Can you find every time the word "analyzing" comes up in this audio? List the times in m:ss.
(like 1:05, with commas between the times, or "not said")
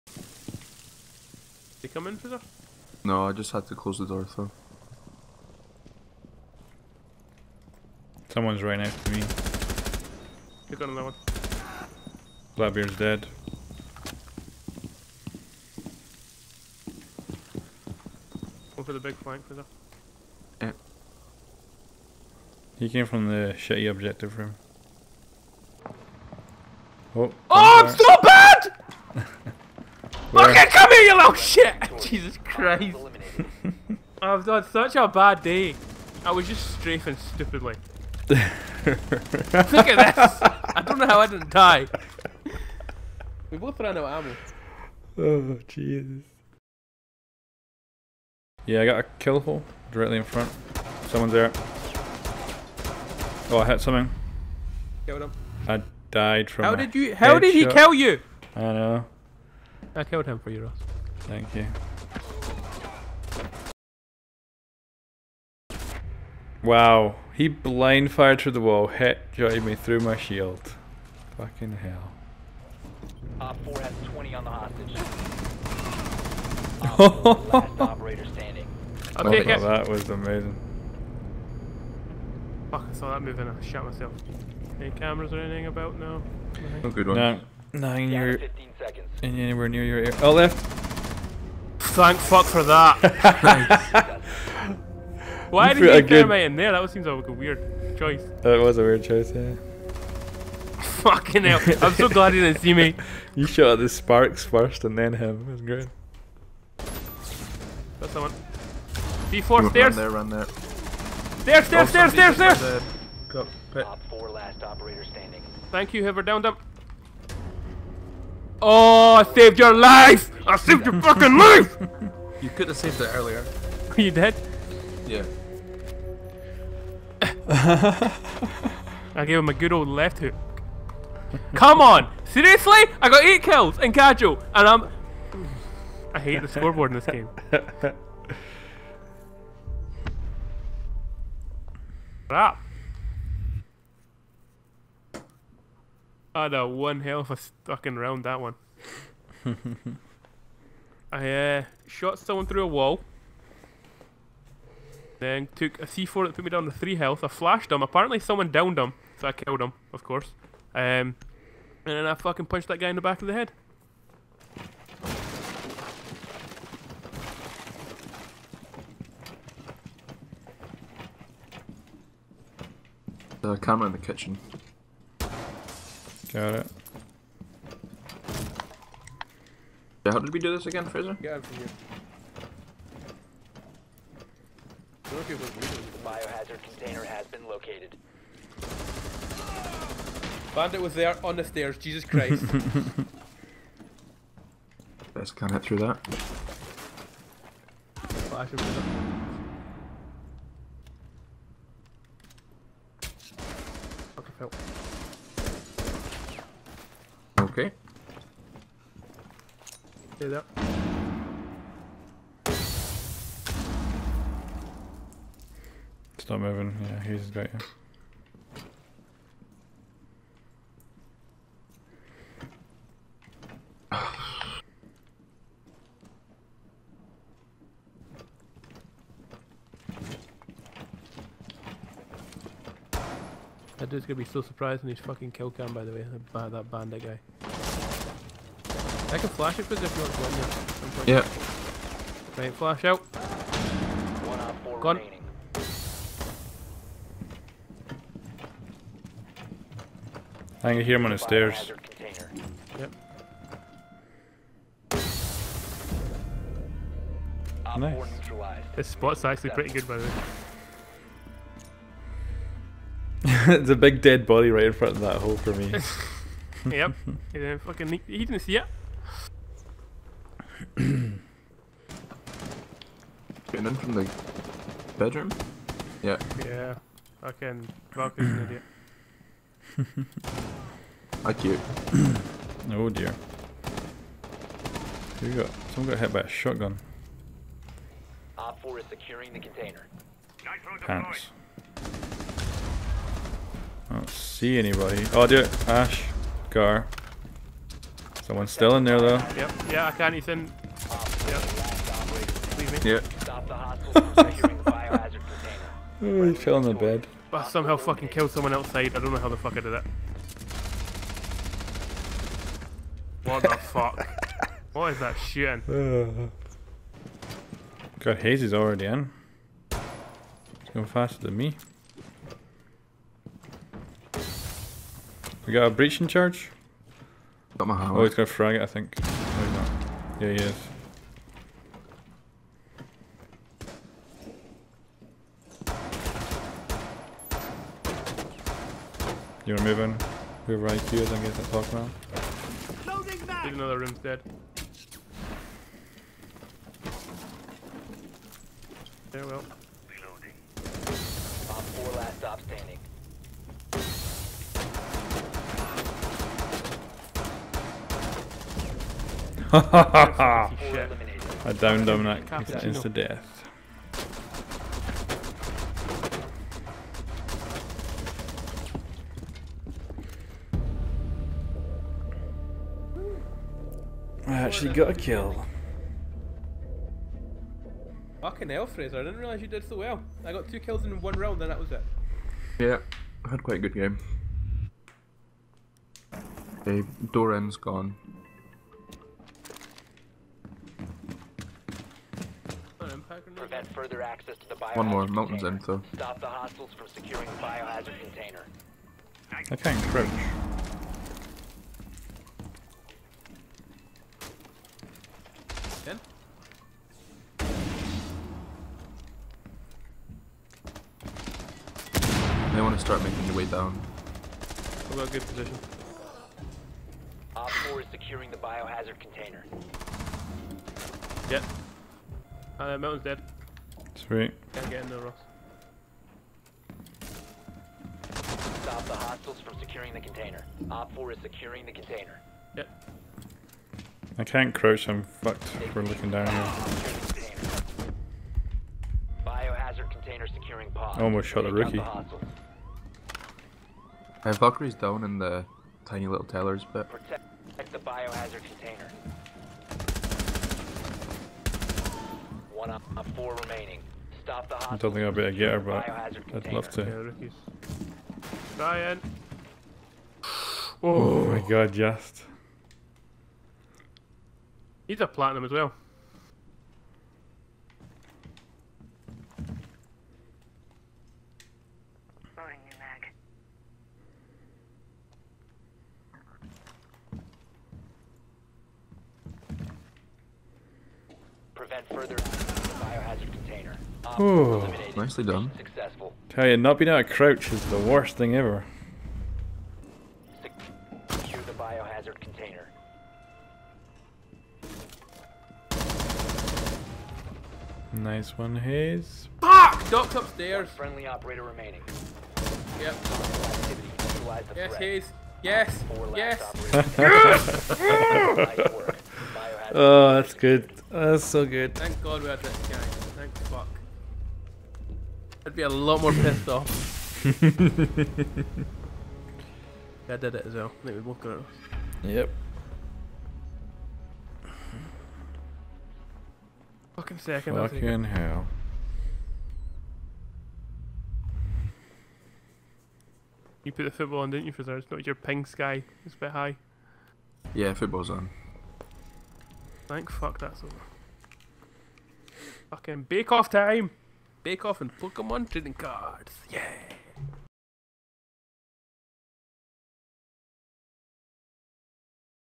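not said.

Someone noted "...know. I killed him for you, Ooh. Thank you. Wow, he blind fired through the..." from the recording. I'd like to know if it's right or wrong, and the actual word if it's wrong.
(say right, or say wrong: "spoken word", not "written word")
wrong: "Ross", not "Ooh".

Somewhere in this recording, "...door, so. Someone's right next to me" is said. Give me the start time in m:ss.
0:04.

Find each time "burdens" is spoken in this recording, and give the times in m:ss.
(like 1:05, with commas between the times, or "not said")
not said.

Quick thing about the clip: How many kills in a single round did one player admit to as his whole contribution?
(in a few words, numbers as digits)
2.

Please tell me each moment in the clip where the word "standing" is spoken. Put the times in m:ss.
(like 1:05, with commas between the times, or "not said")
1:18, 1:55, 5:52.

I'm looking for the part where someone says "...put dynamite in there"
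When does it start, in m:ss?
1:35.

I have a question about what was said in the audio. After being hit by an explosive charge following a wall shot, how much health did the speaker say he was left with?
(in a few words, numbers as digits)
3.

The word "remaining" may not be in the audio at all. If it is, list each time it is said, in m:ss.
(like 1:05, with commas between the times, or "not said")
4:04, 7:33, 8:21.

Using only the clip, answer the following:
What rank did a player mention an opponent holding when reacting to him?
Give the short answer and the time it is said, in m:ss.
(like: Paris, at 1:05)
Platinum, at 7:45.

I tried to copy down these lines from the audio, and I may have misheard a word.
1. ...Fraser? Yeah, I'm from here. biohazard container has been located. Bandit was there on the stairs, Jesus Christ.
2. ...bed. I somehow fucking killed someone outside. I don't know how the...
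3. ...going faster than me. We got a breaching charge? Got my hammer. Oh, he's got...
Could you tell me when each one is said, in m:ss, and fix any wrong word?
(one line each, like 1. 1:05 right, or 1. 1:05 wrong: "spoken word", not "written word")
1. 3:00 right
2. 5:06 right
3. 5:20 right.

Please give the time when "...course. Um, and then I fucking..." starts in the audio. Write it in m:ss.
2:40.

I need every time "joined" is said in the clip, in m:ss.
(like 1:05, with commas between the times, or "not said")
1:09.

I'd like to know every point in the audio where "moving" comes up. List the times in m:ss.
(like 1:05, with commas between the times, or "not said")
1:23, 3:36, 5:39.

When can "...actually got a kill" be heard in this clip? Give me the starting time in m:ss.
6:14.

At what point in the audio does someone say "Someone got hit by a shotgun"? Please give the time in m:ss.
4:45.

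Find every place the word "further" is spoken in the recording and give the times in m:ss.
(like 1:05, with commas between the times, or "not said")
6:33, 8:01.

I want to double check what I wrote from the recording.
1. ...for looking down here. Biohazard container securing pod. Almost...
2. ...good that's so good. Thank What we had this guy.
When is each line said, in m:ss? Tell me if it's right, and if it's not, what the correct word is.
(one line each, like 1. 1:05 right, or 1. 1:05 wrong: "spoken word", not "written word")
1. 7:15 right
2. 8:30 wrong: "God", not "What".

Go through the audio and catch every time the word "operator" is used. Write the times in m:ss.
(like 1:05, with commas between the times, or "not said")
1:17, 1:54, 8:21.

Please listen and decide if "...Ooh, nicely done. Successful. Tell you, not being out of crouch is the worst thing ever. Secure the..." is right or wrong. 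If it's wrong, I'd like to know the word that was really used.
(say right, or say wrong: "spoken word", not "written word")
right.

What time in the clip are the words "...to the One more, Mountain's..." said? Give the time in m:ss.
6:34.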